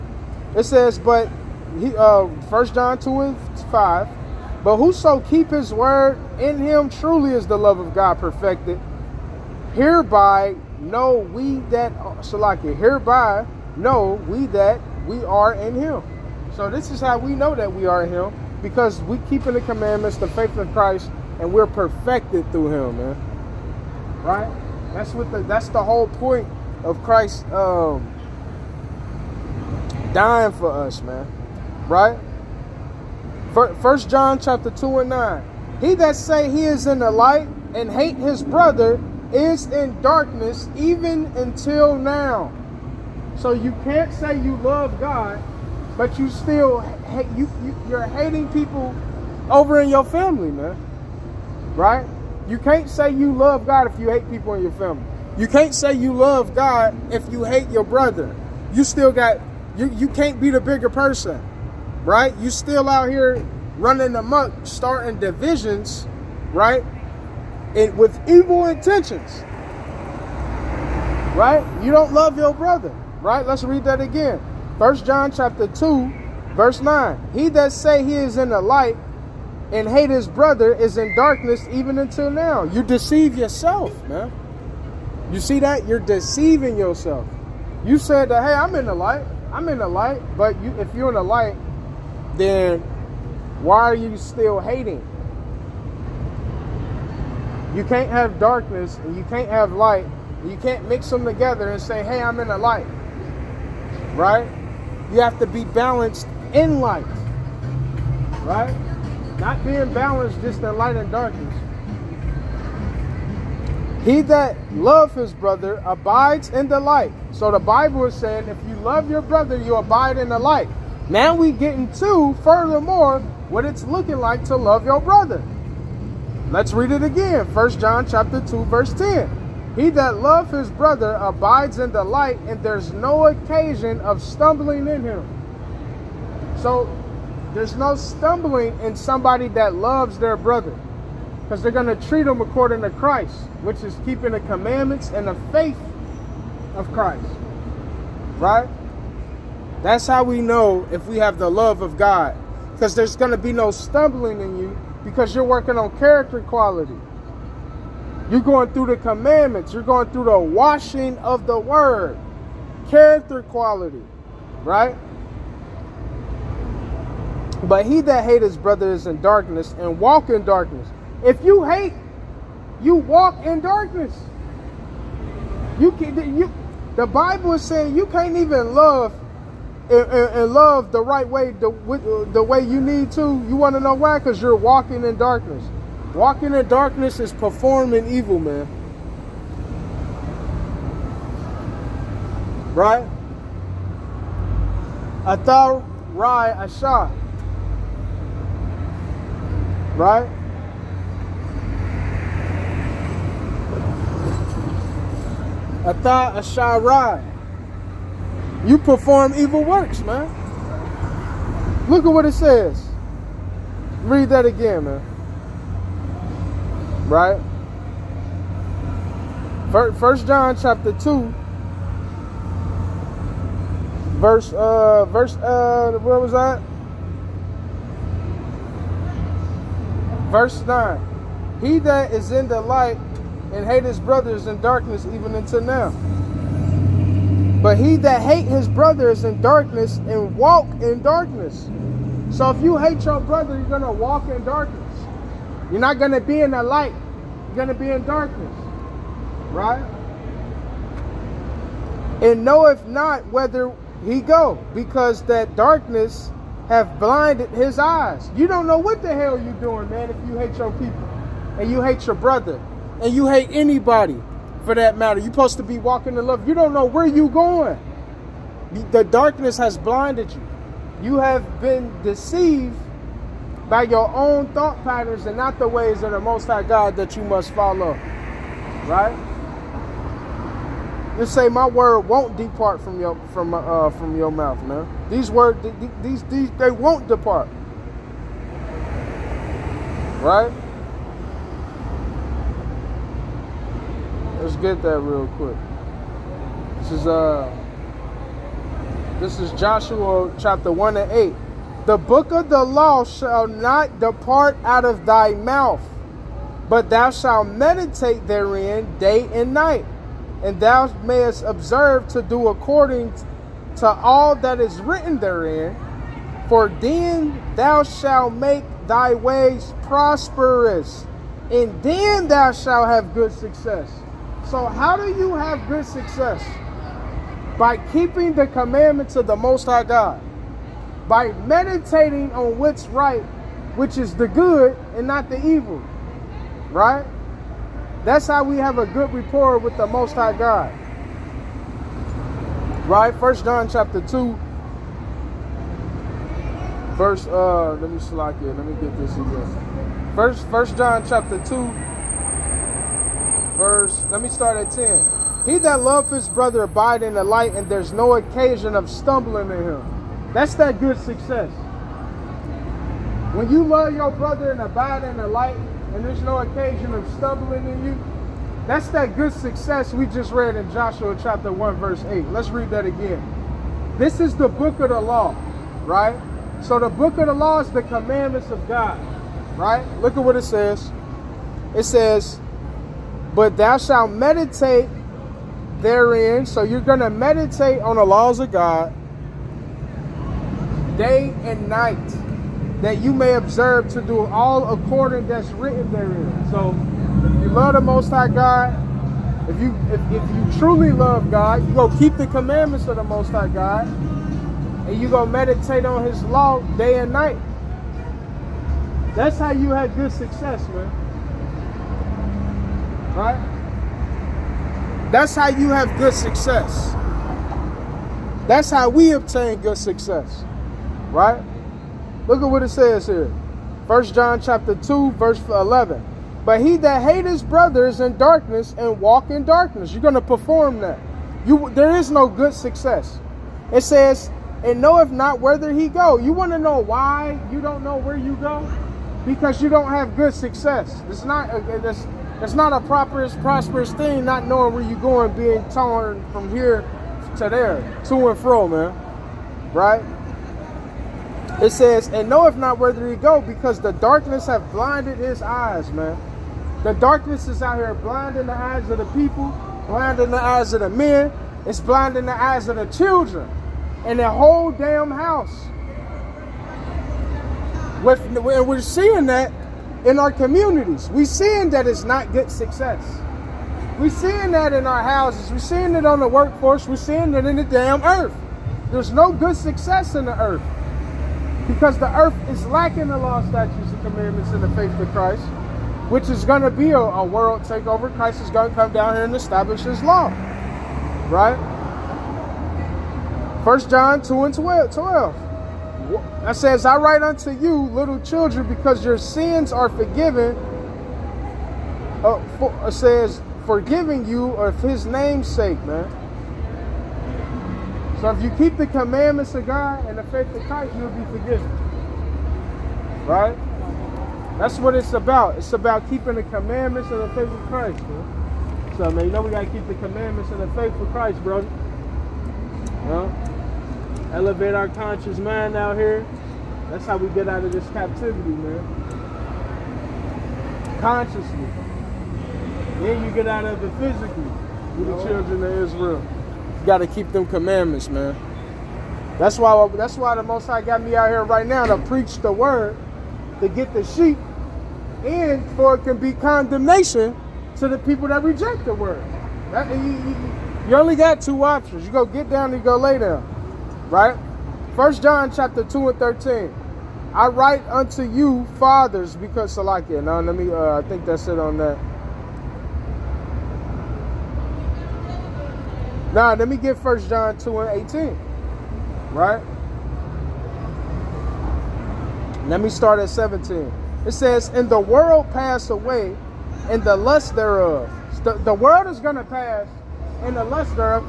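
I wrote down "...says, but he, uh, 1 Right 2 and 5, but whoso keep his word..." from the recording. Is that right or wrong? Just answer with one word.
wrong.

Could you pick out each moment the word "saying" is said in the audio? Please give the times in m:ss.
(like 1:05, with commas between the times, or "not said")
1:58, 2:57.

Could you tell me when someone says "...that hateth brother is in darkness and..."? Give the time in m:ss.
7:06.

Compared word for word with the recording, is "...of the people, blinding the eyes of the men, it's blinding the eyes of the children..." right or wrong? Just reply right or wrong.
right.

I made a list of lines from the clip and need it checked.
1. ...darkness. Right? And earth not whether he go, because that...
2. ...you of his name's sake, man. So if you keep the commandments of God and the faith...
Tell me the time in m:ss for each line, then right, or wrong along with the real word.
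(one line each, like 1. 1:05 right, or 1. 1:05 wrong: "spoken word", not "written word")
1. 4:08 wrong: "knoweth", not "earth"
2. 8:24 right.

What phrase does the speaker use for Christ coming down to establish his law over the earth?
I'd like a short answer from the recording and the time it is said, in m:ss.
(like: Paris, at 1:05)
world takeover, at 8:07.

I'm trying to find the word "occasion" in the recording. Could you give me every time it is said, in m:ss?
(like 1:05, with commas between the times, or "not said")
2:13, 5:58, 6:06.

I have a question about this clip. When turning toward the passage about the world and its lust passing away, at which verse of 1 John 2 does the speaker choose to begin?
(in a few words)
17.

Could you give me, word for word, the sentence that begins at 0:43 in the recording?
So you can't say you love God, but you still you, you you're hating people over in your family, man.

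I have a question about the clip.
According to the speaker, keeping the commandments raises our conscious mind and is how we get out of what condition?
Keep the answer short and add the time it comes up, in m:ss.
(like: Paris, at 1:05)
captivity, at 8:47.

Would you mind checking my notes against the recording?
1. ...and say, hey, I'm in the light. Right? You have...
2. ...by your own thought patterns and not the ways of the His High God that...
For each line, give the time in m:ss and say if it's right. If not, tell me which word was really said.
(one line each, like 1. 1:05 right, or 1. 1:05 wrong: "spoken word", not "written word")
1. 1:41 right
2. 4:33 wrong: "Most", not "His".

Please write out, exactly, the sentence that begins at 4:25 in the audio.
You're supposed to be walking in love.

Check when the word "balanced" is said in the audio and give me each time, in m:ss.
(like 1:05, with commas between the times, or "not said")
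1:45, 1:49.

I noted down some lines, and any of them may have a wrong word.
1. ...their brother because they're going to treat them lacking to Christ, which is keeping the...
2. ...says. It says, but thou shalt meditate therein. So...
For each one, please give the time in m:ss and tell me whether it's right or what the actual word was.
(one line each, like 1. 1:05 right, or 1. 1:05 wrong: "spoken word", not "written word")
1. 2:20 wrong: "according", not "lacking"
2. 6:20 right.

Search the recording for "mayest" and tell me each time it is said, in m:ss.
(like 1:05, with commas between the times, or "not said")
5:11.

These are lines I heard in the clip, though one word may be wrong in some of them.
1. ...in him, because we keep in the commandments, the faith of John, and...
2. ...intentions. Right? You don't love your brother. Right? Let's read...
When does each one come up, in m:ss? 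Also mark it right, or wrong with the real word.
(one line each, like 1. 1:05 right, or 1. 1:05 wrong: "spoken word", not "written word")
1. 0:18 wrong: "Christ", not "John"
2. 1:08 right.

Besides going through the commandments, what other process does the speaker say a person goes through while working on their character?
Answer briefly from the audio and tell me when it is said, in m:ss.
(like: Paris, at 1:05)
washing of the word, at 2:40.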